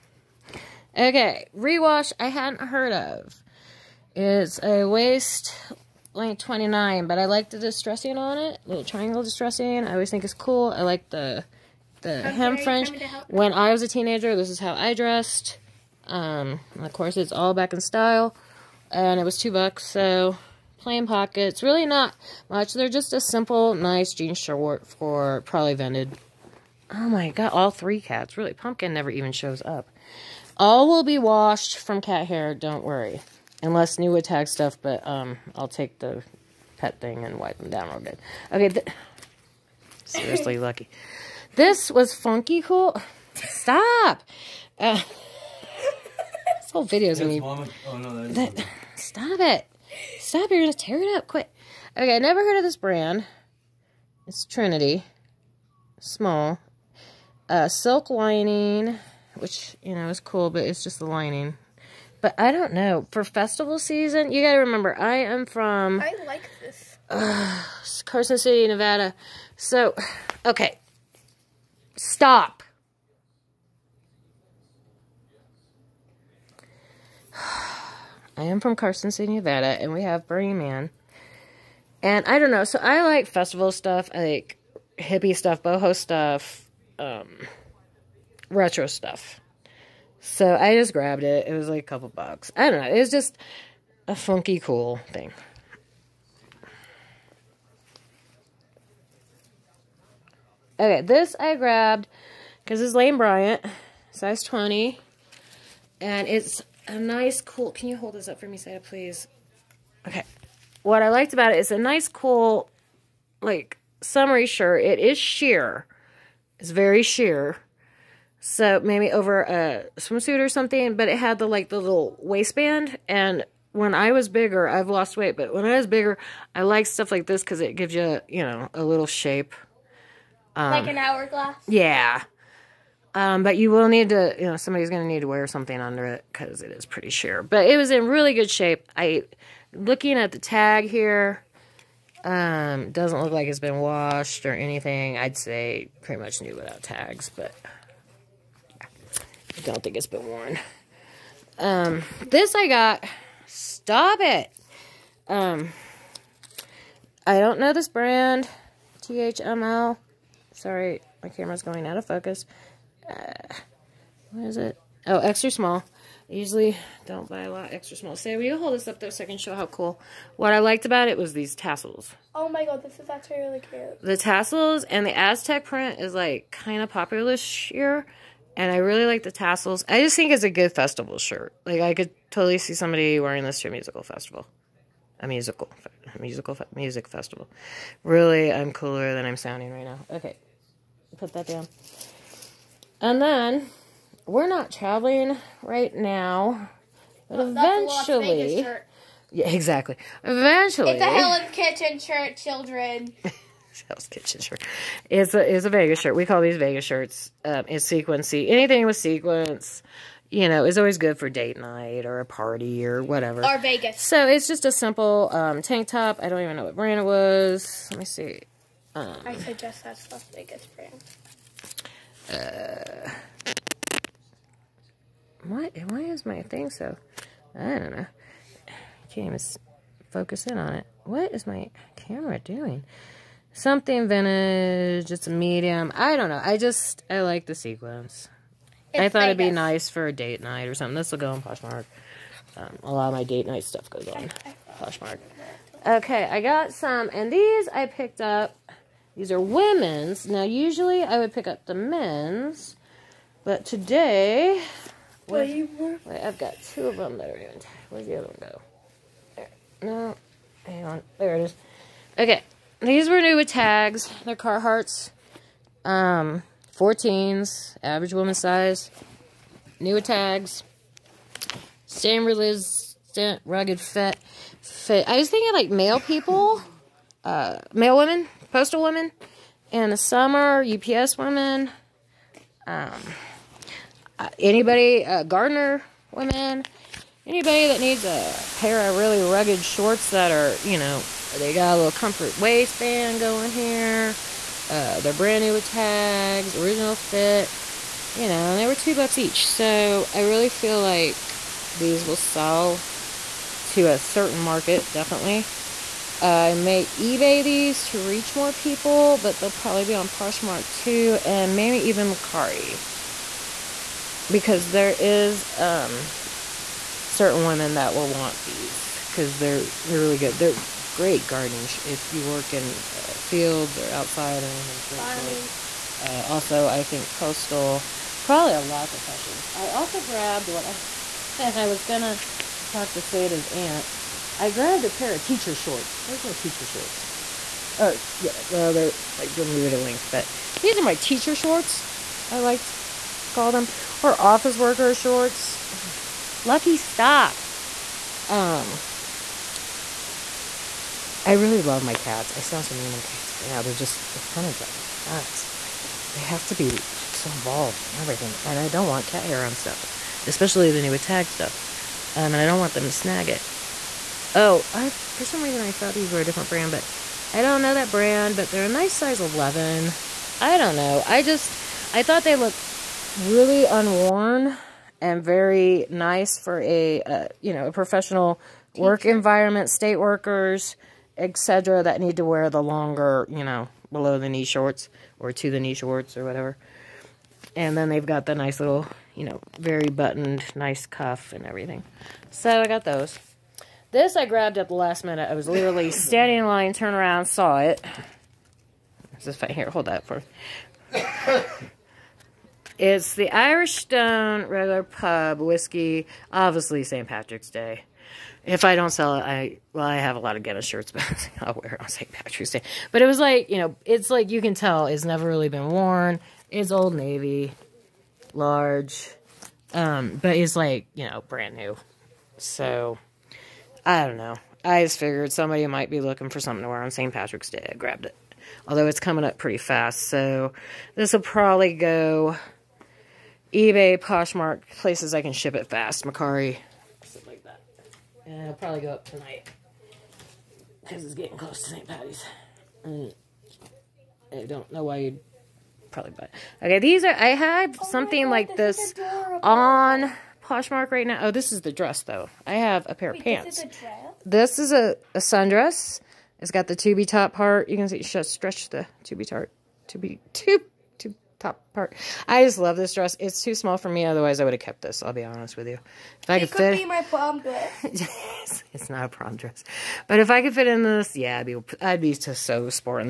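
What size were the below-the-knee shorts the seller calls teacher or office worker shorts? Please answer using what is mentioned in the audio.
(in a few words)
11.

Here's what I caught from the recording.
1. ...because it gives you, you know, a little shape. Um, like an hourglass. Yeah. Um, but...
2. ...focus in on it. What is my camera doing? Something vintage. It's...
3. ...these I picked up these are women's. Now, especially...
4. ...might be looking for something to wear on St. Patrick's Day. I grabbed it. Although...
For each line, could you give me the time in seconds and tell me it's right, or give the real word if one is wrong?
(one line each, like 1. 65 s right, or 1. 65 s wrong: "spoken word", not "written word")
1. 127 s right
2. 230 s right
3. 247 s wrong: "usually", not "especially"
4. 425 s right.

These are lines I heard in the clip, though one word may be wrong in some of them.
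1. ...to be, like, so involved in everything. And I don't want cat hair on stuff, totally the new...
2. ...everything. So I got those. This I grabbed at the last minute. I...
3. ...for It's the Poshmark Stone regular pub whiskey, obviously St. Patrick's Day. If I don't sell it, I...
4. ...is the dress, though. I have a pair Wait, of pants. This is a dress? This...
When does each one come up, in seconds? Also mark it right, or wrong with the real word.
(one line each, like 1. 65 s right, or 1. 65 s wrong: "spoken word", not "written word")
1. 356 s wrong: "especially", not "totally"
2. 391 s right
3. 400 s wrong: "Irish", not "Poshmark"
4. 451 s right.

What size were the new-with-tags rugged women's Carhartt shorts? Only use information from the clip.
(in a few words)
14.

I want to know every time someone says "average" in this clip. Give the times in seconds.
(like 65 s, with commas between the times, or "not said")
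267 s.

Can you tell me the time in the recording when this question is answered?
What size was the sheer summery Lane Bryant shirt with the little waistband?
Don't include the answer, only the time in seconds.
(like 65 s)
104 s.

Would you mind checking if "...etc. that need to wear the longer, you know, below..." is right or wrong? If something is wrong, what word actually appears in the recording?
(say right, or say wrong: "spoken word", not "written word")
right.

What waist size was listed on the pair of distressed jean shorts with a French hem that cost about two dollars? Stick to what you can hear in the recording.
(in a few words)
29.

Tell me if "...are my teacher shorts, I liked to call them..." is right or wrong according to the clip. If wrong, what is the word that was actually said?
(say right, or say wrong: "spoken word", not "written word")
right.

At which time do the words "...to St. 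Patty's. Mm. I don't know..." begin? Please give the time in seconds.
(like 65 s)
441 s.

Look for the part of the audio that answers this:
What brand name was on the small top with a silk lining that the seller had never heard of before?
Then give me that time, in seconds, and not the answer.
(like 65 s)
54 s.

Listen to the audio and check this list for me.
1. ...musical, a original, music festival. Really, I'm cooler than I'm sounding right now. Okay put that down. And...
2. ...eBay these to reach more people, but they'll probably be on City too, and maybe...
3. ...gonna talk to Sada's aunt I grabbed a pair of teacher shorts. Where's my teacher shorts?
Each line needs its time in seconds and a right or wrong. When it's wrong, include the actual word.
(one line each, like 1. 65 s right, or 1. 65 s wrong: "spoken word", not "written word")
1. 185 s wrong: "musical", not "original"
2. 306 s wrong: "Poshmark", not "City"
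3. 331 s right.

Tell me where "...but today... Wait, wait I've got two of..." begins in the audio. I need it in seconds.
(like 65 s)
253 s.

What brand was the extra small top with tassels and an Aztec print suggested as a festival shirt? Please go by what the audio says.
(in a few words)
THML.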